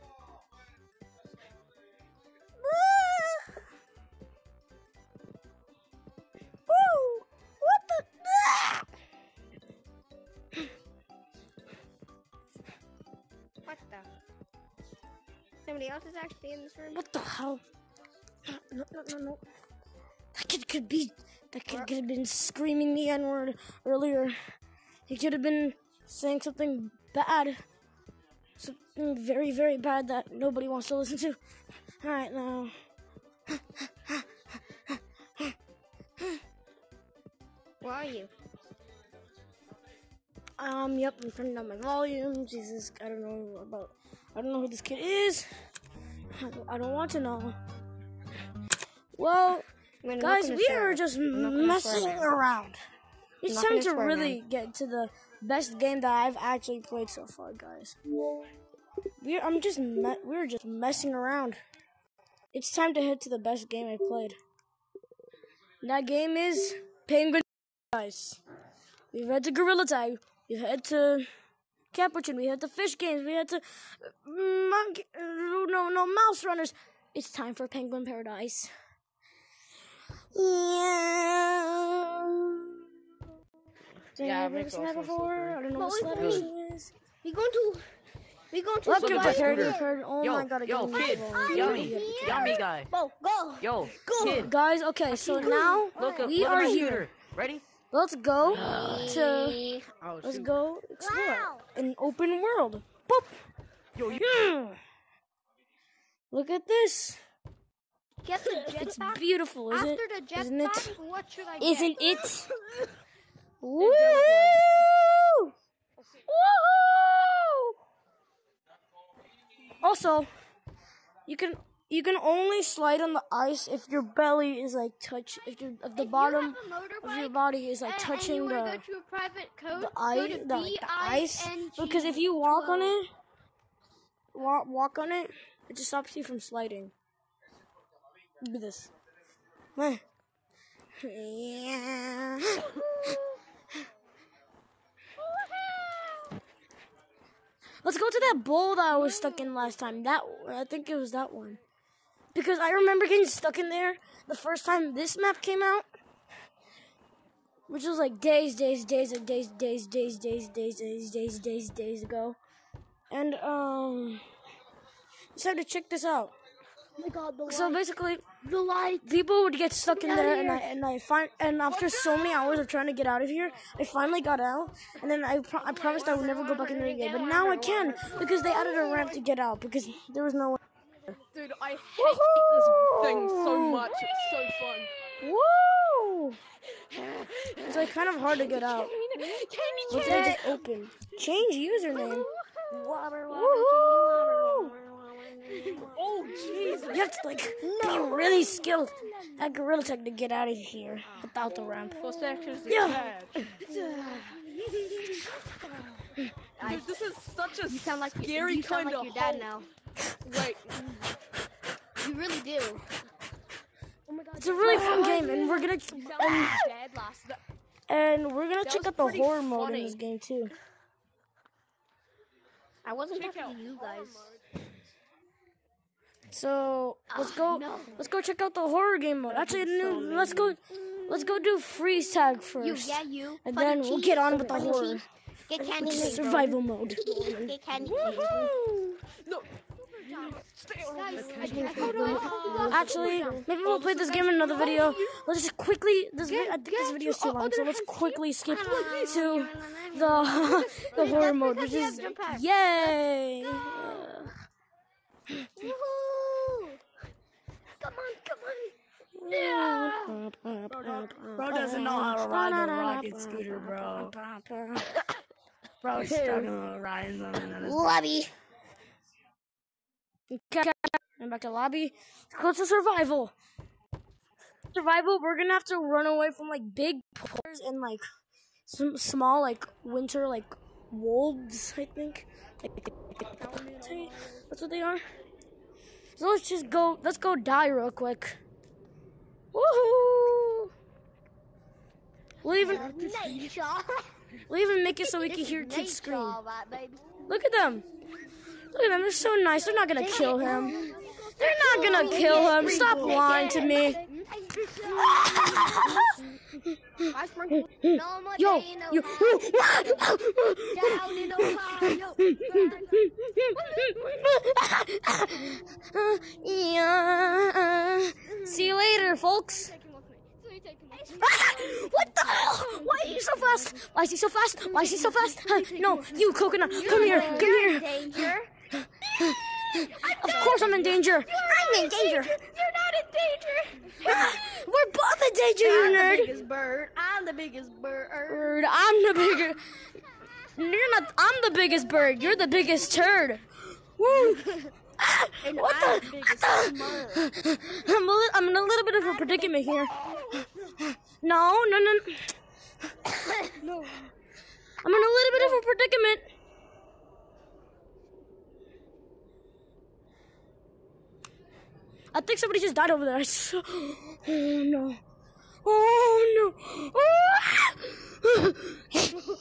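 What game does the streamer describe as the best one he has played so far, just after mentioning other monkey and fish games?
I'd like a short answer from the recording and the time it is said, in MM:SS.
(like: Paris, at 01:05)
Penguin Guys, at 01:07.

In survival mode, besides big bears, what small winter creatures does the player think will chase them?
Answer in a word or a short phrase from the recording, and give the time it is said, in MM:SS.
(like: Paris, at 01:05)
Wolves, at 04:40.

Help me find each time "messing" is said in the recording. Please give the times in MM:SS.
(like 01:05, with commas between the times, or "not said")
00:51, 01:00.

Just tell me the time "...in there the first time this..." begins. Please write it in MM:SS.
02:33.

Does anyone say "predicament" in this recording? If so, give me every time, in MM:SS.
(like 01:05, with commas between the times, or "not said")
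05:49, 05:55.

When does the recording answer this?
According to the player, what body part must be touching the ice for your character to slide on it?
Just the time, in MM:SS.
02:04.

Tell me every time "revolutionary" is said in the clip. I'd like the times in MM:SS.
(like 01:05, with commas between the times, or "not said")
not said.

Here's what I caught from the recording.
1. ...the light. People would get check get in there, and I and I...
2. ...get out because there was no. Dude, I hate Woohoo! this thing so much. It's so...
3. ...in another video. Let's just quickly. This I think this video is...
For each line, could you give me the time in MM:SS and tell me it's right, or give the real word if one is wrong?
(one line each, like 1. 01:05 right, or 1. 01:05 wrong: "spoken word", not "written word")
1. 02:48 wrong: "stuck", not "check"
2. 02:59 right
3. 04:04 right.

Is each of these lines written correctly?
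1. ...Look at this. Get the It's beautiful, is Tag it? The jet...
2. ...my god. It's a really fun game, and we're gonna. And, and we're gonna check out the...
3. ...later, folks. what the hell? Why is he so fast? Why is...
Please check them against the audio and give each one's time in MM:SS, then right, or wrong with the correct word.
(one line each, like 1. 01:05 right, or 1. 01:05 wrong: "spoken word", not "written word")
1. 01:46 wrong: "After", not "Tag"
2. 03:34 right
3. 05:18 right.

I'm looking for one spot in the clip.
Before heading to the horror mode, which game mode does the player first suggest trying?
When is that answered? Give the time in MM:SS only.
03:51.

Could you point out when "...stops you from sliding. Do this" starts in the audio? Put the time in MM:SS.
02:15.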